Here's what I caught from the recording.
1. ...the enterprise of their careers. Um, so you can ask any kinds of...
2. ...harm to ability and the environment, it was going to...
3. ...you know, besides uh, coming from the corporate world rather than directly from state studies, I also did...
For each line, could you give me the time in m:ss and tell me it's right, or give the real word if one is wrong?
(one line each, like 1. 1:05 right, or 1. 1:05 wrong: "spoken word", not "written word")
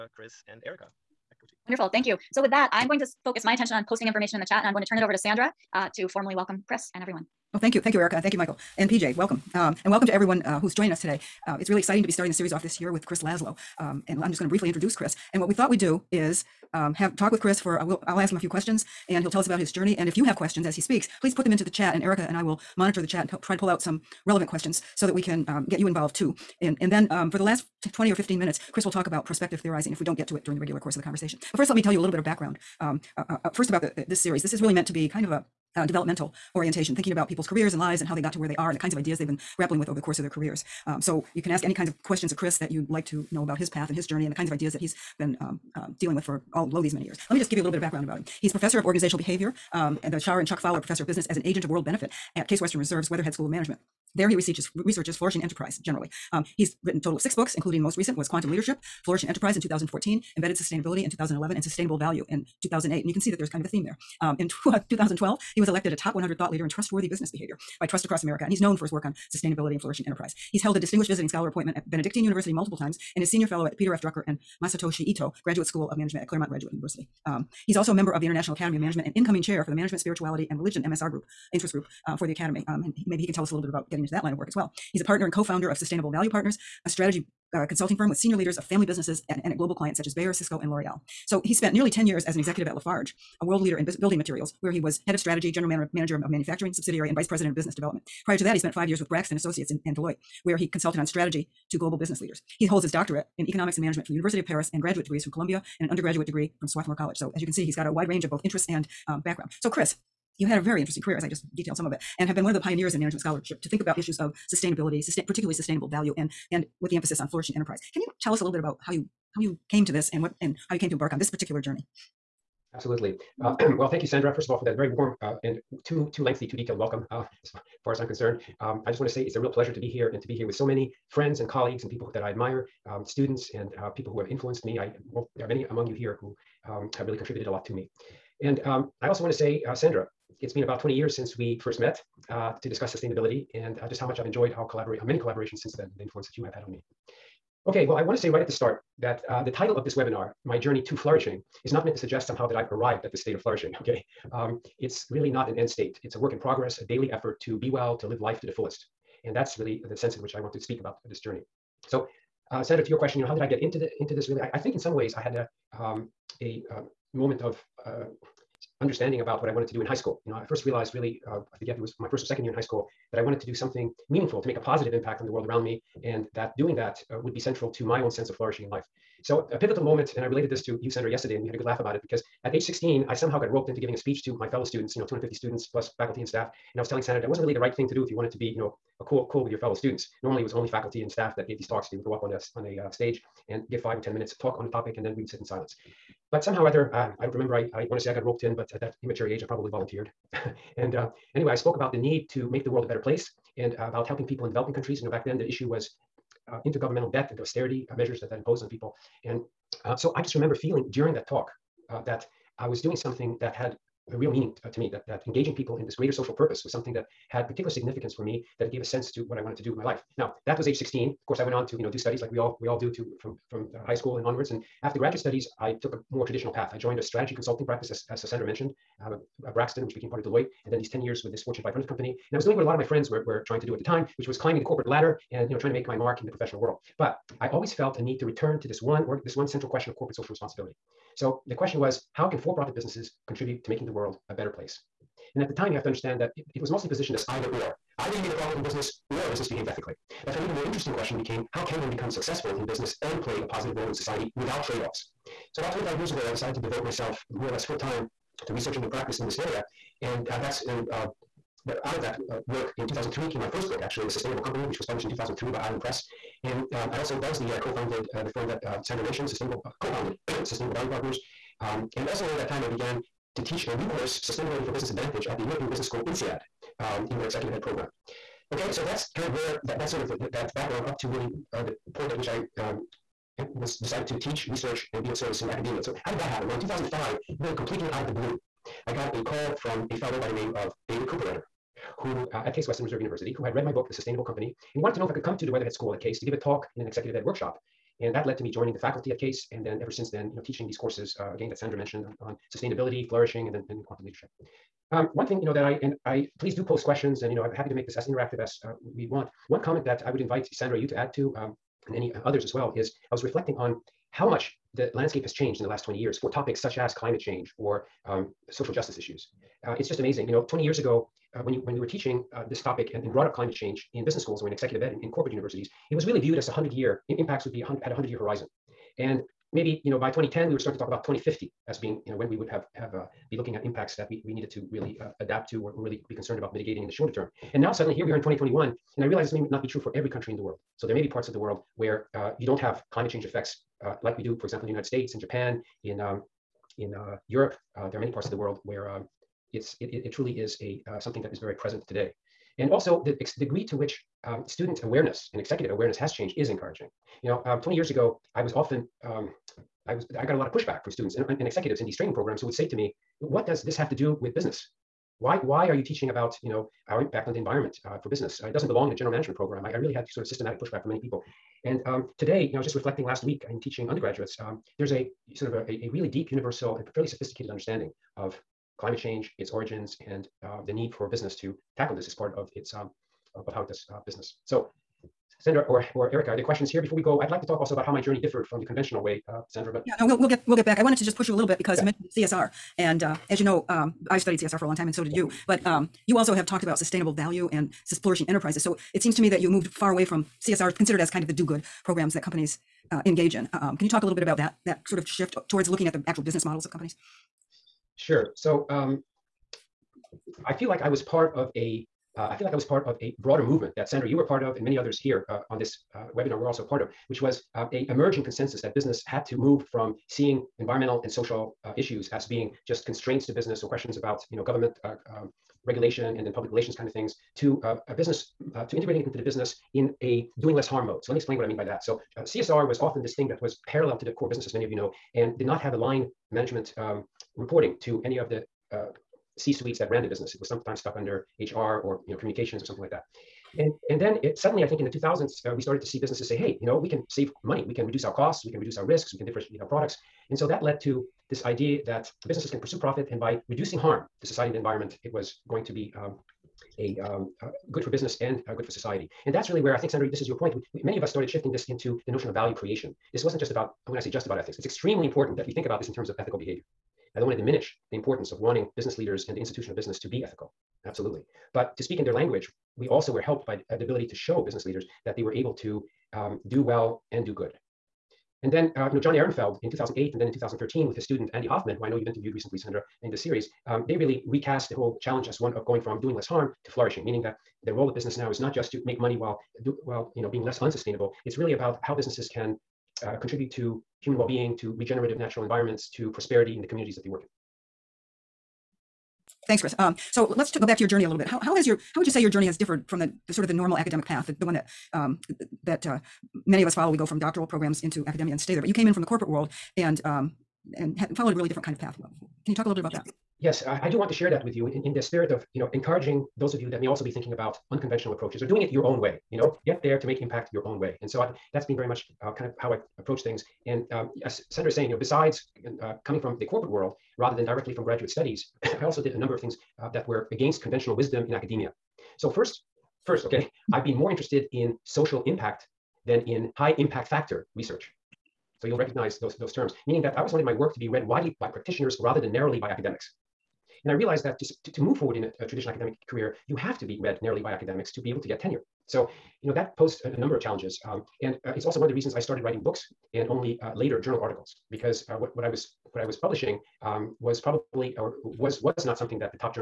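1. 0:39 wrong: "course", not "enterprise"
2. 7:33 wrong: "society", not "ability"
3. 8:44 wrong: "graduate", not "state".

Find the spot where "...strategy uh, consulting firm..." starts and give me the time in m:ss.
1:26.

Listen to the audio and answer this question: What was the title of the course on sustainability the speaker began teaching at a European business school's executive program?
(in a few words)
Sustainability for Business Advantage.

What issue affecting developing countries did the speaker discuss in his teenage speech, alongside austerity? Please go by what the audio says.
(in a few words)
intergovernmental debt.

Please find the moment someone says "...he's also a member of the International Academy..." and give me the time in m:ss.
1:17.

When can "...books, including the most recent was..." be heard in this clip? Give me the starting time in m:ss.
0:57.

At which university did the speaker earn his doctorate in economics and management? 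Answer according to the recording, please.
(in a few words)
University of Paris.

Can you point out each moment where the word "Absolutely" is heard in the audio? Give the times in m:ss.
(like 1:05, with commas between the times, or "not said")
2:02, 7:50.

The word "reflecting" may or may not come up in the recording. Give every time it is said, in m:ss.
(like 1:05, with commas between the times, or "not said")
5:13, 6:12.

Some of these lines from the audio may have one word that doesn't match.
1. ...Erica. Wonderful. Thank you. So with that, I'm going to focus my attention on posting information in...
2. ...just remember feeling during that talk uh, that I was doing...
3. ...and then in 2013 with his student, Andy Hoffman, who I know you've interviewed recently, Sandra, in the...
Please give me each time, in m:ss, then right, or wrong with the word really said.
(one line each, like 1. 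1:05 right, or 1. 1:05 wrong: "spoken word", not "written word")
1. 0:00 right
2. 3:30 right
3. 8:00 right.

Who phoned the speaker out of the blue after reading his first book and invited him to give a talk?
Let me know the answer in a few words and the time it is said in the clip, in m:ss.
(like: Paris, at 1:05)
David Cooperrider, at 4:50.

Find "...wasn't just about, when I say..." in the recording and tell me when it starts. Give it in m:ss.
7:43.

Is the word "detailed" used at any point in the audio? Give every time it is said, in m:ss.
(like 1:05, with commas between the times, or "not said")
1:51, 2:06.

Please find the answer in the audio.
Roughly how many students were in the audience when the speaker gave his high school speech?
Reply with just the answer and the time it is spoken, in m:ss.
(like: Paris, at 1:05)
250, at 3:05.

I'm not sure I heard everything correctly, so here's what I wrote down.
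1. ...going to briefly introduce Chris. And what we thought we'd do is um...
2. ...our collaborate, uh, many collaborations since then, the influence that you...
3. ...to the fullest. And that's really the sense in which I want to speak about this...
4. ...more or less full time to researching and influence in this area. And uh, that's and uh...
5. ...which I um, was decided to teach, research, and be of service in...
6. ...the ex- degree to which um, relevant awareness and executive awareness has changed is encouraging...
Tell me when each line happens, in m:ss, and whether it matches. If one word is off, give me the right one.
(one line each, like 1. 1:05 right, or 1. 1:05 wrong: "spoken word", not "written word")
1. 0:14 right
2. 2:24 right
3. 2:38 right
4. 4:17 wrong: "practice", not "influence"
5. 4:42 right
6. 5:53 wrong: "student", not "relevant".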